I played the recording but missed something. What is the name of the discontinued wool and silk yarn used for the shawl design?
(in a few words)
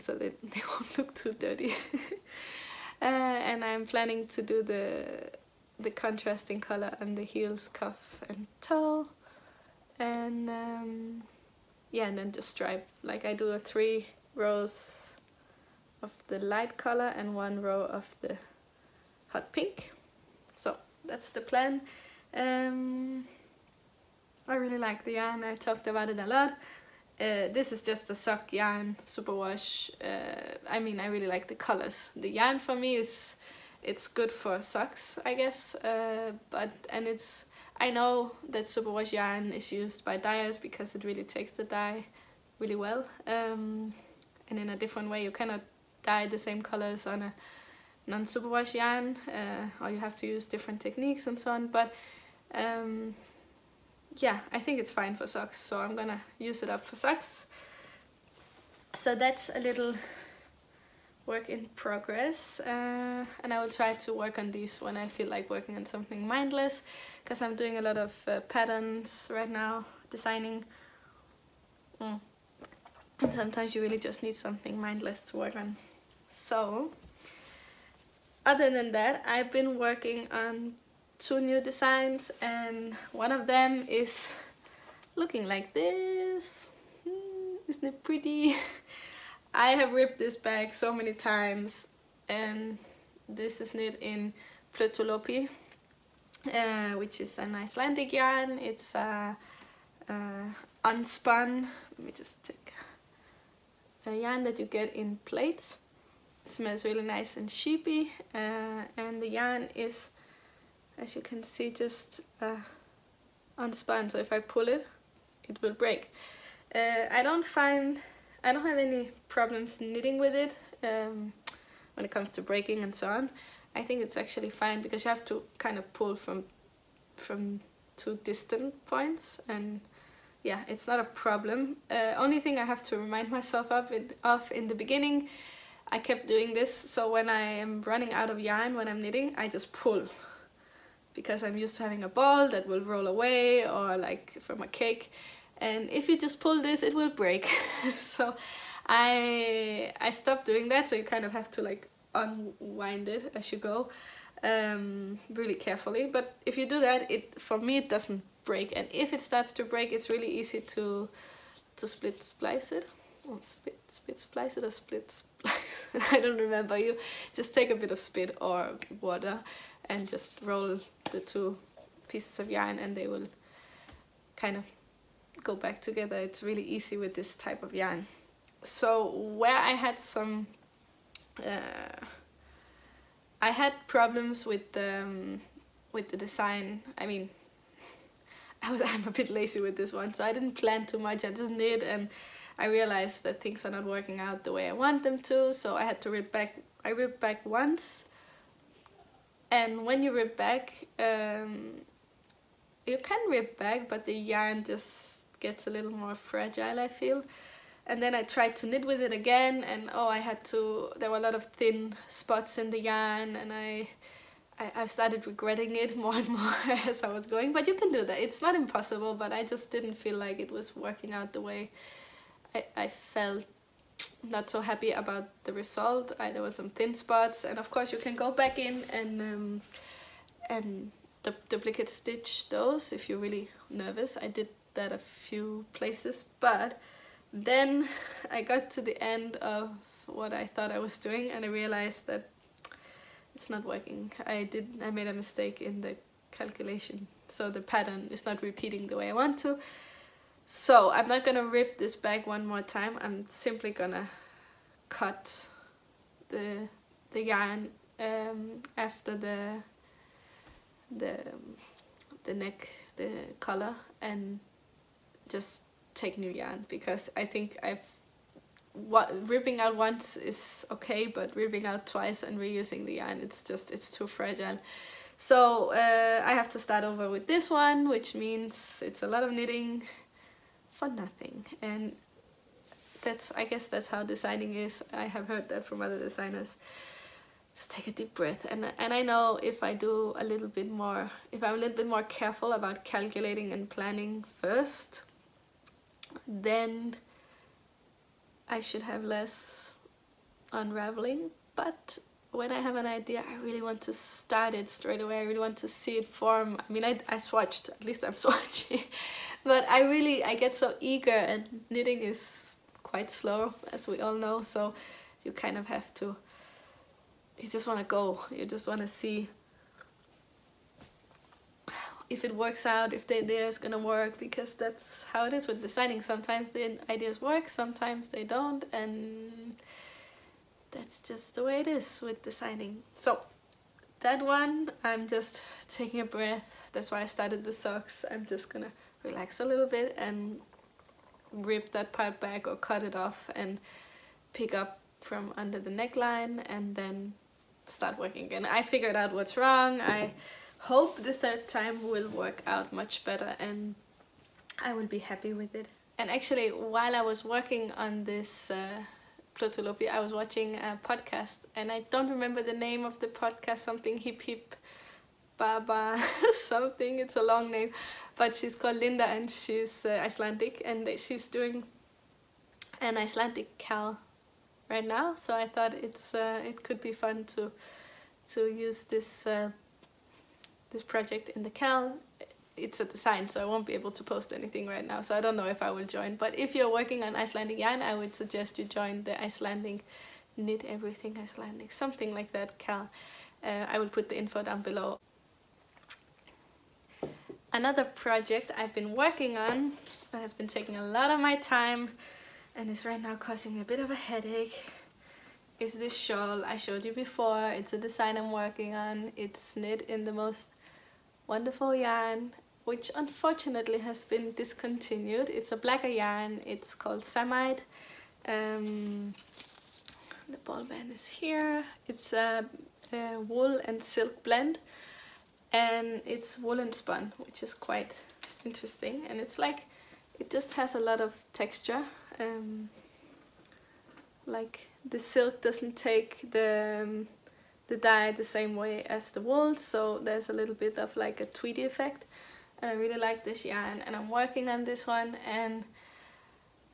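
Samite.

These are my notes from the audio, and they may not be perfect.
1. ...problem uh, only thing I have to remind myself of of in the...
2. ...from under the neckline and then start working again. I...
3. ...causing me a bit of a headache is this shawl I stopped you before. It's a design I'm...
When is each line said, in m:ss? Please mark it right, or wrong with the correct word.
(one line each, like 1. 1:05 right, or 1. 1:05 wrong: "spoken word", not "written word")
1. 2:11 right
2. 5:45 right
3. 6:43 wrong: "showed", not "stopped".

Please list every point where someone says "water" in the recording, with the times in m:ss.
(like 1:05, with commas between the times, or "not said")
2:49.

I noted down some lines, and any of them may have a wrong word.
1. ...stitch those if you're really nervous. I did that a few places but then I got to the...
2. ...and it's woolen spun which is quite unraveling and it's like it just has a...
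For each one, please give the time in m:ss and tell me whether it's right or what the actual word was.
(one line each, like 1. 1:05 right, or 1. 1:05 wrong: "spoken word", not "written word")
1. 3:51 right
2. 7:05 wrong: "interesting", not "unraveling".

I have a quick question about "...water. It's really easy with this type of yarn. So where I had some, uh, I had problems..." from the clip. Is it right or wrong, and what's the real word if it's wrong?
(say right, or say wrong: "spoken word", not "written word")
wrong: "together", not "water".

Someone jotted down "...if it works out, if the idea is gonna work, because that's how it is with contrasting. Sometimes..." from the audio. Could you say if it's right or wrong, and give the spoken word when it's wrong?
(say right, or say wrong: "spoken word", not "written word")
wrong: "designing", not "contrasting".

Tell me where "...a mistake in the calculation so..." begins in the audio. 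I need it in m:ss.
4:05.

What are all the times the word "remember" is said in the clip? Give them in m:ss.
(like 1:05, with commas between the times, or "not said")
2:46, 6:02.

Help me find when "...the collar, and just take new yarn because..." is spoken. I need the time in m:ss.
4:22.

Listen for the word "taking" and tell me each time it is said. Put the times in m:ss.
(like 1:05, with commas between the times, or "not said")
5:35, 6:40.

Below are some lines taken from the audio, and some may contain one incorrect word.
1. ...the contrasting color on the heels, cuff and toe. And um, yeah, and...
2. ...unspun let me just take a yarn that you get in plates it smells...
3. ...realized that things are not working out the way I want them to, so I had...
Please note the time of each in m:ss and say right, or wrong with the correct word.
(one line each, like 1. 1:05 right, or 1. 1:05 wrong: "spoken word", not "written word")
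1. 0:05 right
2. 1:40 right
3. 3:12 right.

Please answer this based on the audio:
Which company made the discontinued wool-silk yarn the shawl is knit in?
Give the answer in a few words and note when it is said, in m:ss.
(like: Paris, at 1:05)
Blacker, at 6:55.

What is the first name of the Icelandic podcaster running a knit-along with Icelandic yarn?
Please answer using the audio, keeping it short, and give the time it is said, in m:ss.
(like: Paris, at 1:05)
Linda, at 6:08.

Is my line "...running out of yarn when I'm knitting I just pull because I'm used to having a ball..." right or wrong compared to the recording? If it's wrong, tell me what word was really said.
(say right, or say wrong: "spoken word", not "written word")
right.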